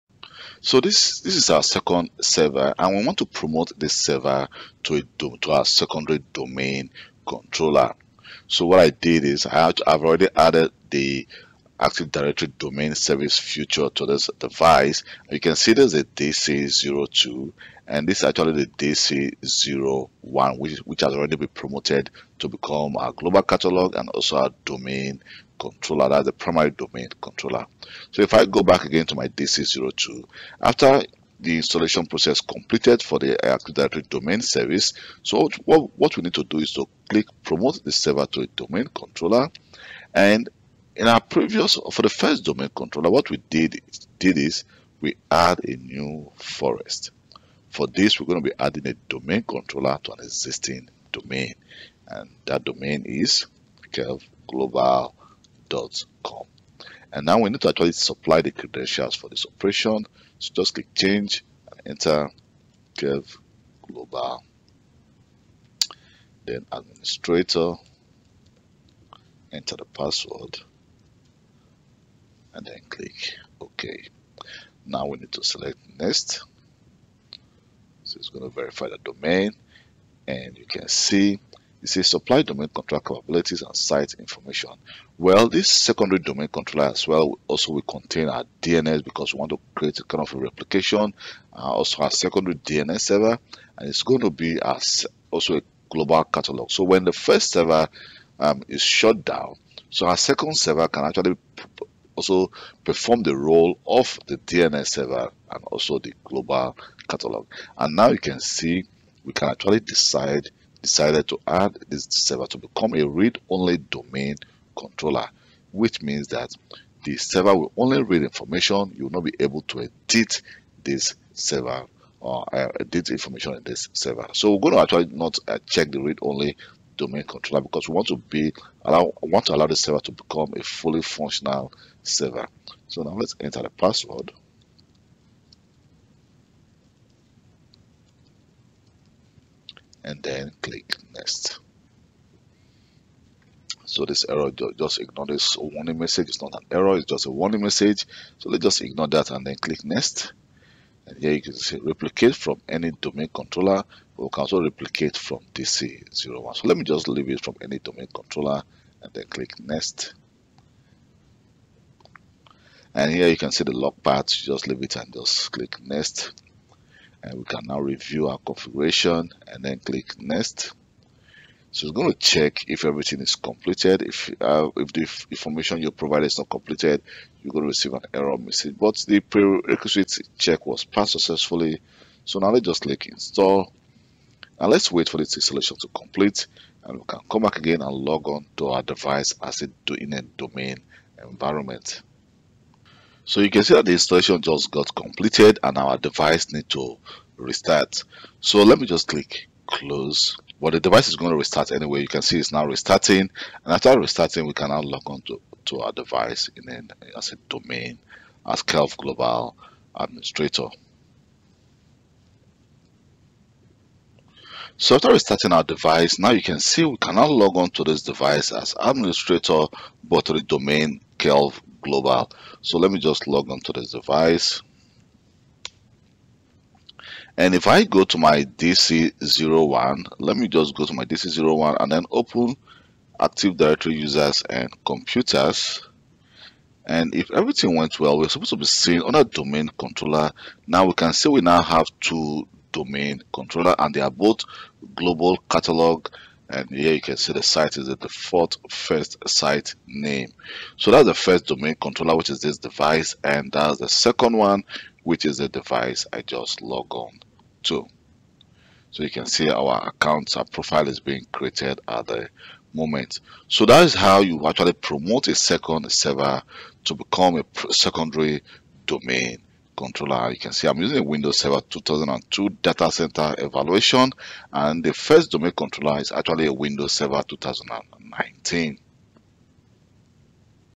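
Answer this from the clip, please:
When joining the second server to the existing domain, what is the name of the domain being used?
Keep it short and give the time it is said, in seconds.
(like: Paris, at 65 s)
Kelv global com, at 53 s.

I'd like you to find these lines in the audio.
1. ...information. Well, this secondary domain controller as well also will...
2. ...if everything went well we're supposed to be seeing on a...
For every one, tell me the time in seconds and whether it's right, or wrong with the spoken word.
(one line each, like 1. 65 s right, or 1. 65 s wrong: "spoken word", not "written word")
1. 84 s right
2. 237 s right.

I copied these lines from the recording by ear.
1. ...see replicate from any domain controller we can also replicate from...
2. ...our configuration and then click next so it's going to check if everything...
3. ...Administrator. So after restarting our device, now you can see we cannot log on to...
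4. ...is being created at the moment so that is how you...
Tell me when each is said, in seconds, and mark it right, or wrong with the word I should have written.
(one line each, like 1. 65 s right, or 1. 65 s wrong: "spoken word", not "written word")
1. 151 s right
2. 168 s right
3. 209 s right
4. 260 s right.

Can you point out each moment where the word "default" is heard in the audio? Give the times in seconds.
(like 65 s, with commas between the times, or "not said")
247 s.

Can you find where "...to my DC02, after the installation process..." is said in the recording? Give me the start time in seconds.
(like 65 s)
29 s.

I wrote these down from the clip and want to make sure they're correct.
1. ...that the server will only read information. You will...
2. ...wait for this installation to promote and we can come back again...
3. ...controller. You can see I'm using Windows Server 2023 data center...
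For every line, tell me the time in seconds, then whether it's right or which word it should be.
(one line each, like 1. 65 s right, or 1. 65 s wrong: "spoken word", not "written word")
1. 116 s right
2. 184 s wrong: "complete", not "promote"
3. 269 s wrong: "2022", not "2023".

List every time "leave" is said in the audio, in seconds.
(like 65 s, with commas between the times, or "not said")
157 s, 164 s.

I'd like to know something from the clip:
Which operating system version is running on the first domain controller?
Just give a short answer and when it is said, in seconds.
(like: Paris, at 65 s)
Windows Server 2019, at 276 s.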